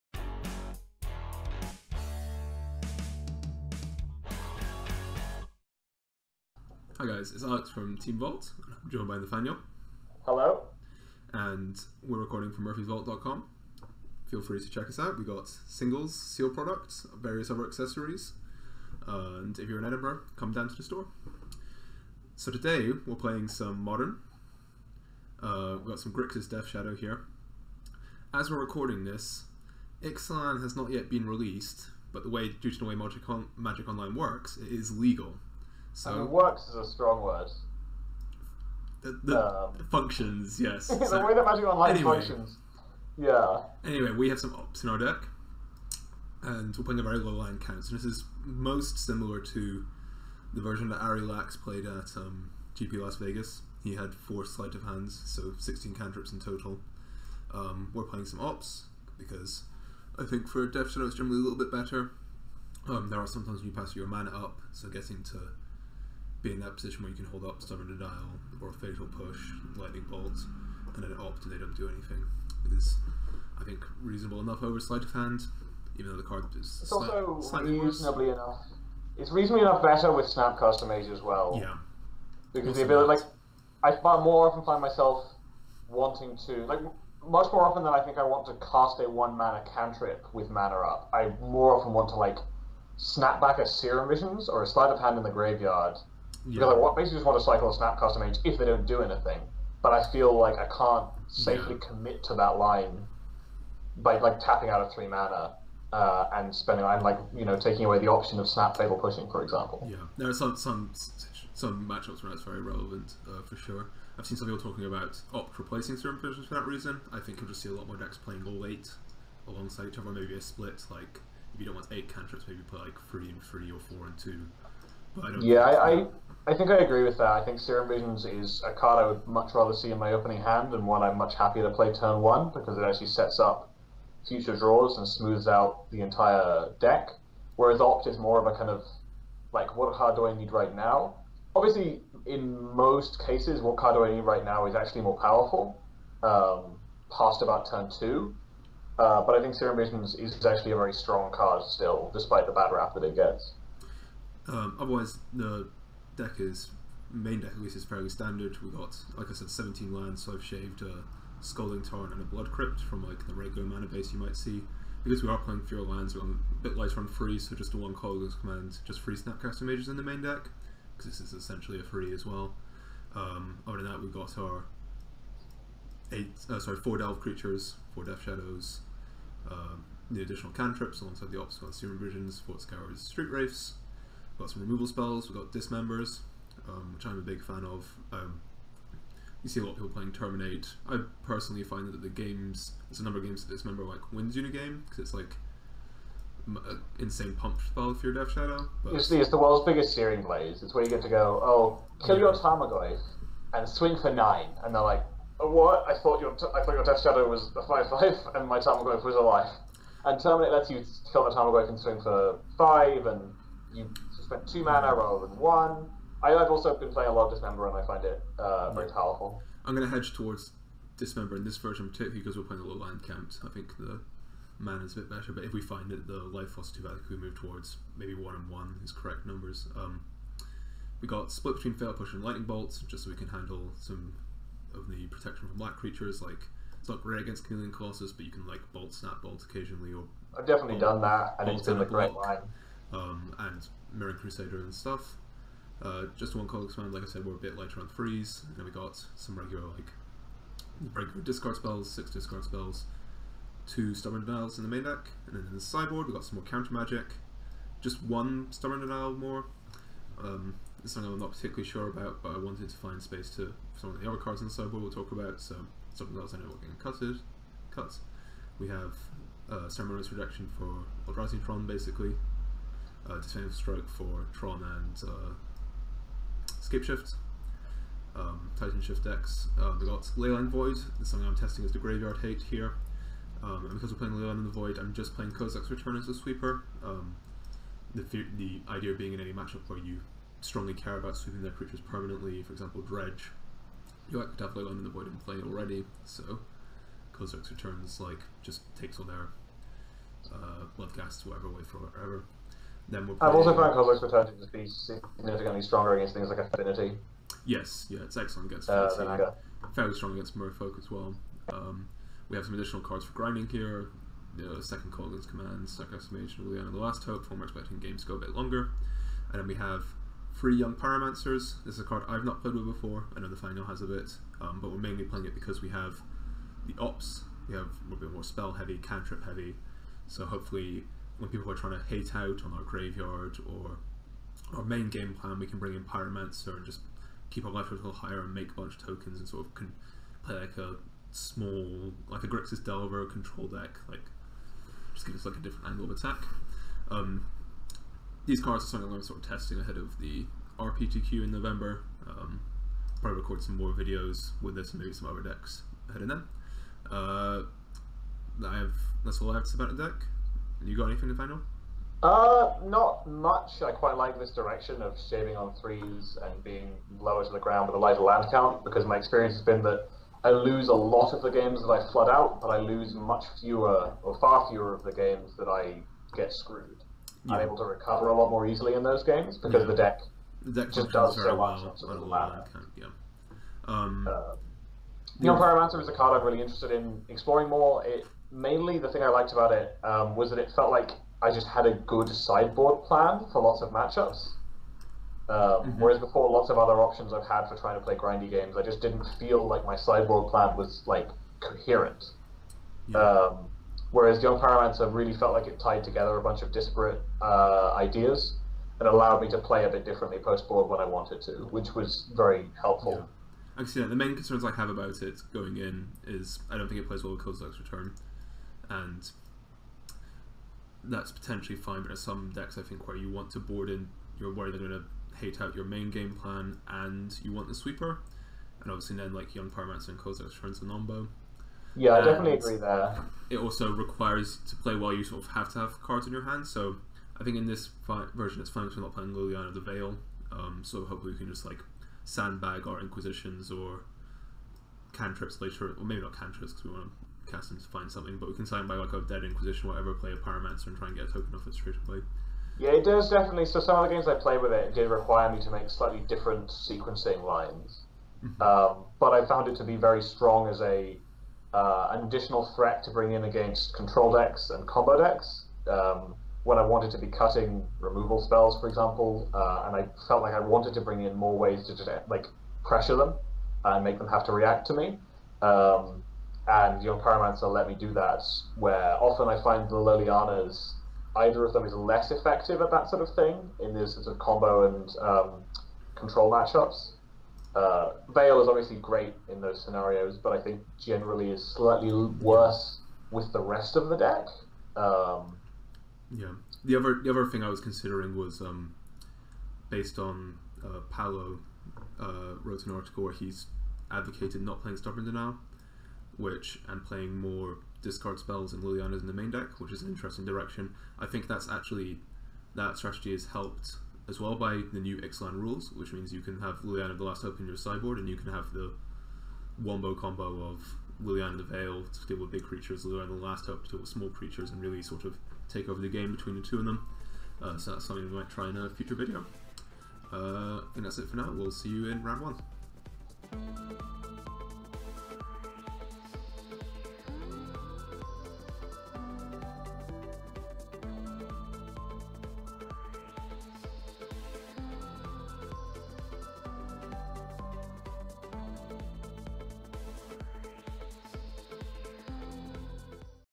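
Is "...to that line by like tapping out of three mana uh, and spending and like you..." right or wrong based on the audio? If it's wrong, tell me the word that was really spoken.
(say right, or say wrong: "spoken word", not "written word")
right.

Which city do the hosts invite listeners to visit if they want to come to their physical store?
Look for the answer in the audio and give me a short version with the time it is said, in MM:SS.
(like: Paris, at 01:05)
Edinburgh, at 00:19.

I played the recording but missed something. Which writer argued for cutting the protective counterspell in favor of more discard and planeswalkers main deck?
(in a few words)
Paulo.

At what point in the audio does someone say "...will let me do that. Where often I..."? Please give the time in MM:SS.
07:57.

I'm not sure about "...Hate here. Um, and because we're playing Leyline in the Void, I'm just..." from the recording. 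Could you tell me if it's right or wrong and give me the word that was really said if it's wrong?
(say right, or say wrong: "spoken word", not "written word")
right.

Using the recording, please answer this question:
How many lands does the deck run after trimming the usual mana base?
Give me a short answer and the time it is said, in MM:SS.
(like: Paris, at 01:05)
17, at 02:39.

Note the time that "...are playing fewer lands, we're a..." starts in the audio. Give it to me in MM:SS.
02:45.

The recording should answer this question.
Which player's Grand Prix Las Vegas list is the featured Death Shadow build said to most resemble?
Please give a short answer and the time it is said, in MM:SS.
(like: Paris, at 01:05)
Ari Lax, at 00:50.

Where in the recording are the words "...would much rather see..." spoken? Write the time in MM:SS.
02:09.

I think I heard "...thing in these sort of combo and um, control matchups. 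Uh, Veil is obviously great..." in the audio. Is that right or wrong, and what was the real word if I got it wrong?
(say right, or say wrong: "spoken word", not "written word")
right.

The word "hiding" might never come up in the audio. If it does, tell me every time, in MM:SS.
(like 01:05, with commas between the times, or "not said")
not said.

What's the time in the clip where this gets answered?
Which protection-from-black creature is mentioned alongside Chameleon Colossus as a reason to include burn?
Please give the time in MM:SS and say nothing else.
04:03.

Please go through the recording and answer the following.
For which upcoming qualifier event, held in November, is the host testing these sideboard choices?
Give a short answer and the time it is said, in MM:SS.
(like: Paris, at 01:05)
RPTQ, at 05:50.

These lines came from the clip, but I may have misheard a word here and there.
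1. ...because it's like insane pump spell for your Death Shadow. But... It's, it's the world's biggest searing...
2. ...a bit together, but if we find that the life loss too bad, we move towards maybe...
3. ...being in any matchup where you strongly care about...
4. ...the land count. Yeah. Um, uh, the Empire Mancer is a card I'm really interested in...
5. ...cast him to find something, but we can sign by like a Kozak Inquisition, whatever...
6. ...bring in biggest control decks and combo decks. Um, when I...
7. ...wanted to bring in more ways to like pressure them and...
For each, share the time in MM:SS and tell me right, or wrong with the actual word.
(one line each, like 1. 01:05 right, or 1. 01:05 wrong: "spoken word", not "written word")
1. 03:14 right
2. 03:44 wrong: "better", not "together"
3. 04:48 right
4. 06:21 right
5. 07:27 wrong: "Dead", not "Kozak"
6. 07:42 wrong: "against", not "biggest"
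7. 07:50 right.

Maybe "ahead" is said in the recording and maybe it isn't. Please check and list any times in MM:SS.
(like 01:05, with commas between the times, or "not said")
05:49, 05:55.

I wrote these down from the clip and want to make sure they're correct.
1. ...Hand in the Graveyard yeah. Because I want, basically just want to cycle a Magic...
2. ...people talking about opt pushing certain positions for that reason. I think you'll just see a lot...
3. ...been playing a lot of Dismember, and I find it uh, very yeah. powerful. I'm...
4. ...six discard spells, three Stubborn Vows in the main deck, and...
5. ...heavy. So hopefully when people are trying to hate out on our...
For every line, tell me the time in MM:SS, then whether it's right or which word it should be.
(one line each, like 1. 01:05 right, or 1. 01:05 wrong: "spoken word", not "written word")
1. 01:34 wrong: "Snapcaster", not "Magic"
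2. 01:54 wrong: "replacing", not "pushing"
3. 03:36 right
4. 04:11 wrong: "two", not "three"
5. 05:29 right.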